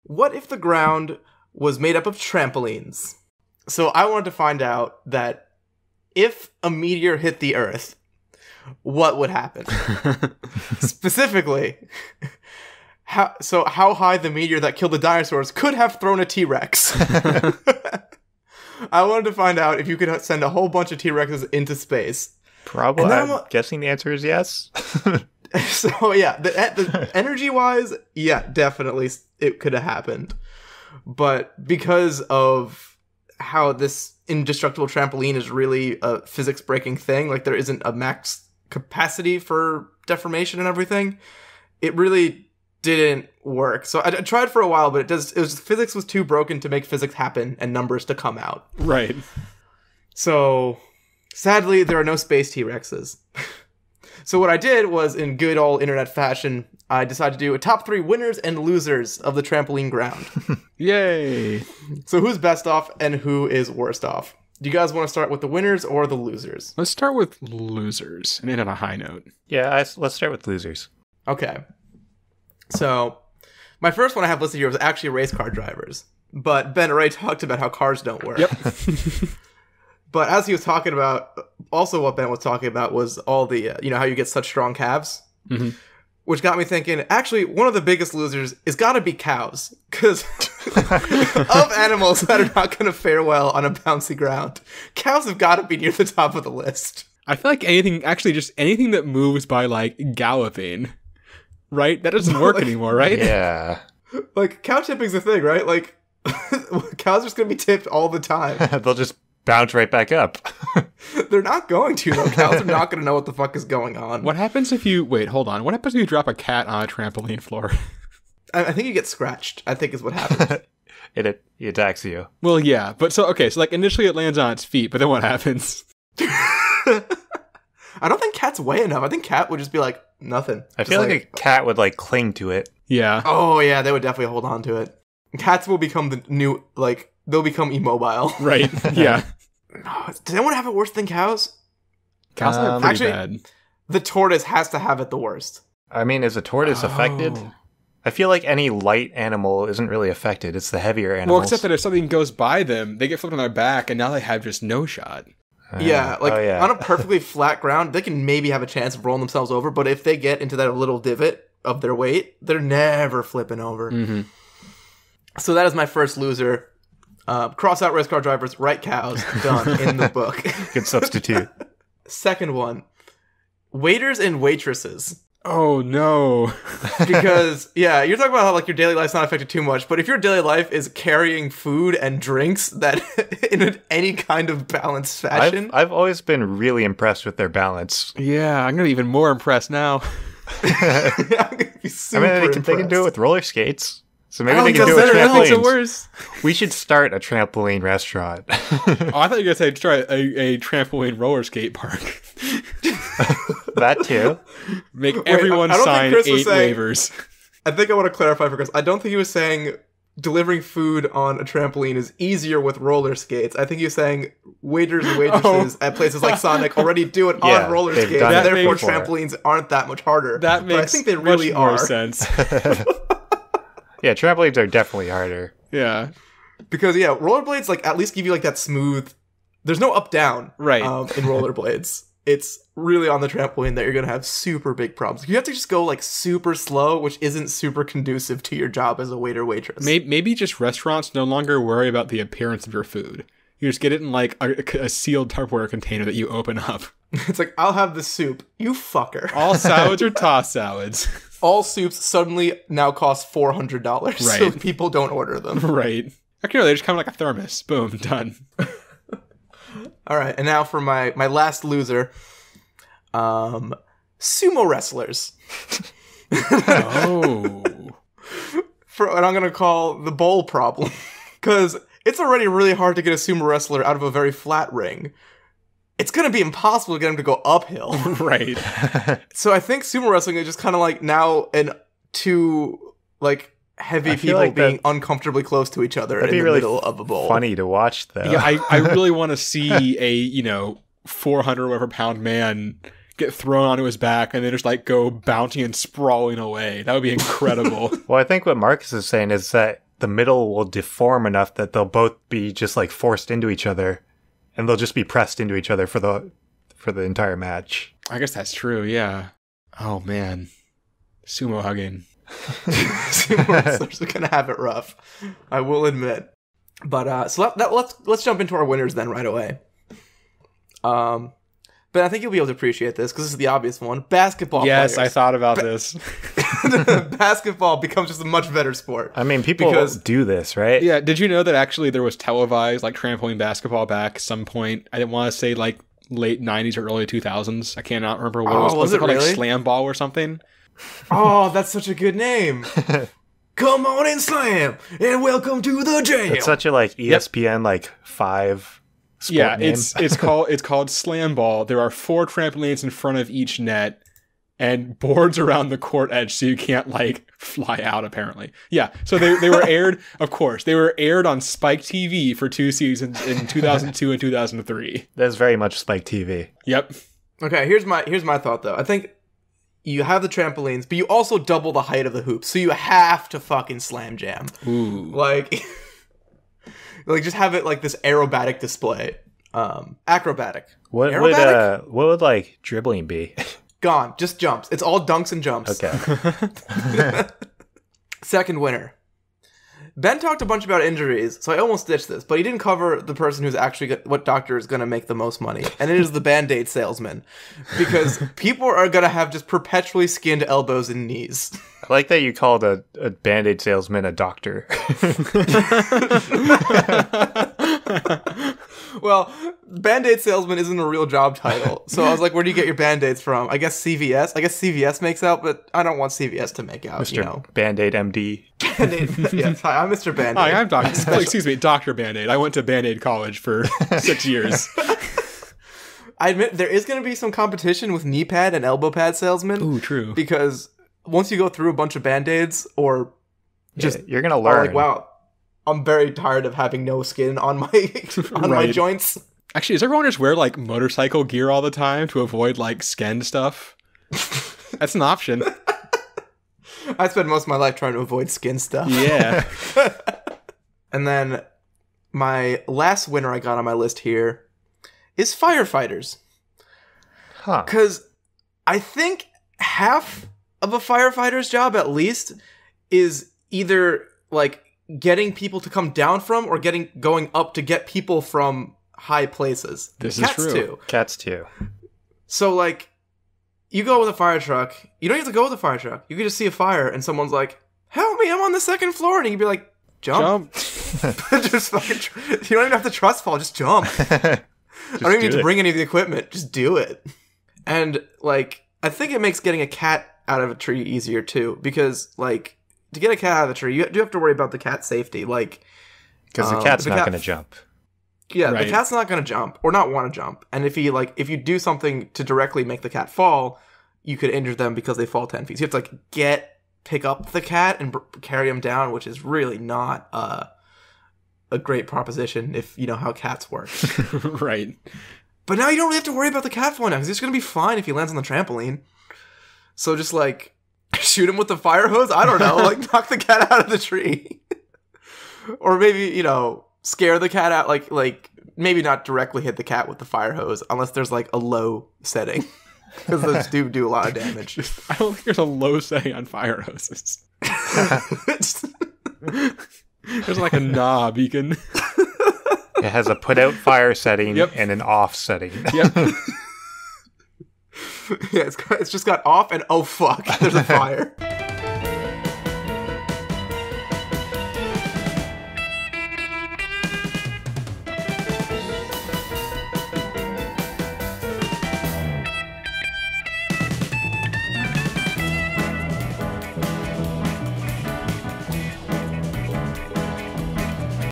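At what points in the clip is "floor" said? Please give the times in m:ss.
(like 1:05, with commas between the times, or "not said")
1:57, 7:58.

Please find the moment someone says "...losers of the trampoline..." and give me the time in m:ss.
0:58.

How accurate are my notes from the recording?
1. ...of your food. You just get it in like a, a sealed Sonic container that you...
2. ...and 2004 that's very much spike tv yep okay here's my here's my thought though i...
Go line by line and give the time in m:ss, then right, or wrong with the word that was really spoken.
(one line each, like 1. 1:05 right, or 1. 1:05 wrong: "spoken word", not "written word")
1. 4:02 wrong: "Tupperware", not "Sonic"
2. 6:04 wrong: "2003", not "2004".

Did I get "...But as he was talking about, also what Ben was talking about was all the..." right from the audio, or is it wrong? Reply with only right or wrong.
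right.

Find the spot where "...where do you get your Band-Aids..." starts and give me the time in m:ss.
6:52.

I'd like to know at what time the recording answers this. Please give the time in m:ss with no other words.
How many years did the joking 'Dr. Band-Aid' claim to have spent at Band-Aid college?
7:03.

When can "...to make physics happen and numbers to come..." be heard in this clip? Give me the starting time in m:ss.
0:46.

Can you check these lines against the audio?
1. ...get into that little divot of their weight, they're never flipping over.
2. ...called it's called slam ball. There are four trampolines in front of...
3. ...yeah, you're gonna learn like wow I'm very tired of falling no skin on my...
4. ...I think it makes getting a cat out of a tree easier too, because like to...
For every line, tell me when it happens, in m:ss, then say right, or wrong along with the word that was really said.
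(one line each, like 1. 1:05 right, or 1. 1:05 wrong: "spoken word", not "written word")
1. 2:40 right
2. 5:50 right
3. 7:13 wrong: "having", not "falling"
4. 8:08 right.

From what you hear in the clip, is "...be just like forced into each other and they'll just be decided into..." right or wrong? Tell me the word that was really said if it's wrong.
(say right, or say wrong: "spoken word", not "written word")
wrong: "pressed", not "decided".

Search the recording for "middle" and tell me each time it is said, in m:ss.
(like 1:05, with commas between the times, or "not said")
4:46, 5:00.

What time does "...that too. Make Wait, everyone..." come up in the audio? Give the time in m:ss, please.
3:23.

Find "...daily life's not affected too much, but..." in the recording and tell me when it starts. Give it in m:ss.
2:58.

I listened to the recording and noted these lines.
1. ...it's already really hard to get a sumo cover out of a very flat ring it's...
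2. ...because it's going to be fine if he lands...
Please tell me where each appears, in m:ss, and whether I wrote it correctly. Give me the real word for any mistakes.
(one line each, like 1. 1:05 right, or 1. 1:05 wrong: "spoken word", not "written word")
1. 4:32 wrong: "wrestler", not "cover"
2. 8:36 right.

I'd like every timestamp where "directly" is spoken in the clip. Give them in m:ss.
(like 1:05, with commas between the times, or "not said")
8:22, 8:49.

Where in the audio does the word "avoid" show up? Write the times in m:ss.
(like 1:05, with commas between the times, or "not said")
7:22, 7:27.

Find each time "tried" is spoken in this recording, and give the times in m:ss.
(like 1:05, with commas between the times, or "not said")
0:44.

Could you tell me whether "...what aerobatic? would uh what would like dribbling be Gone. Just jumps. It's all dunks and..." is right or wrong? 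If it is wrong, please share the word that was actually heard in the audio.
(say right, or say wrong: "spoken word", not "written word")
right.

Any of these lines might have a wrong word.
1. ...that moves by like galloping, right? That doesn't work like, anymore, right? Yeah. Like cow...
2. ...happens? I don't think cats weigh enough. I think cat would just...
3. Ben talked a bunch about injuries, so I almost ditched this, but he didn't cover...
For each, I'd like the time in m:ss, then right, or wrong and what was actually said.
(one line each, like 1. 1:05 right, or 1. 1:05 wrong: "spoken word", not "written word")
1. 1:38 right
2. 2:05 right
3. 6:29 right.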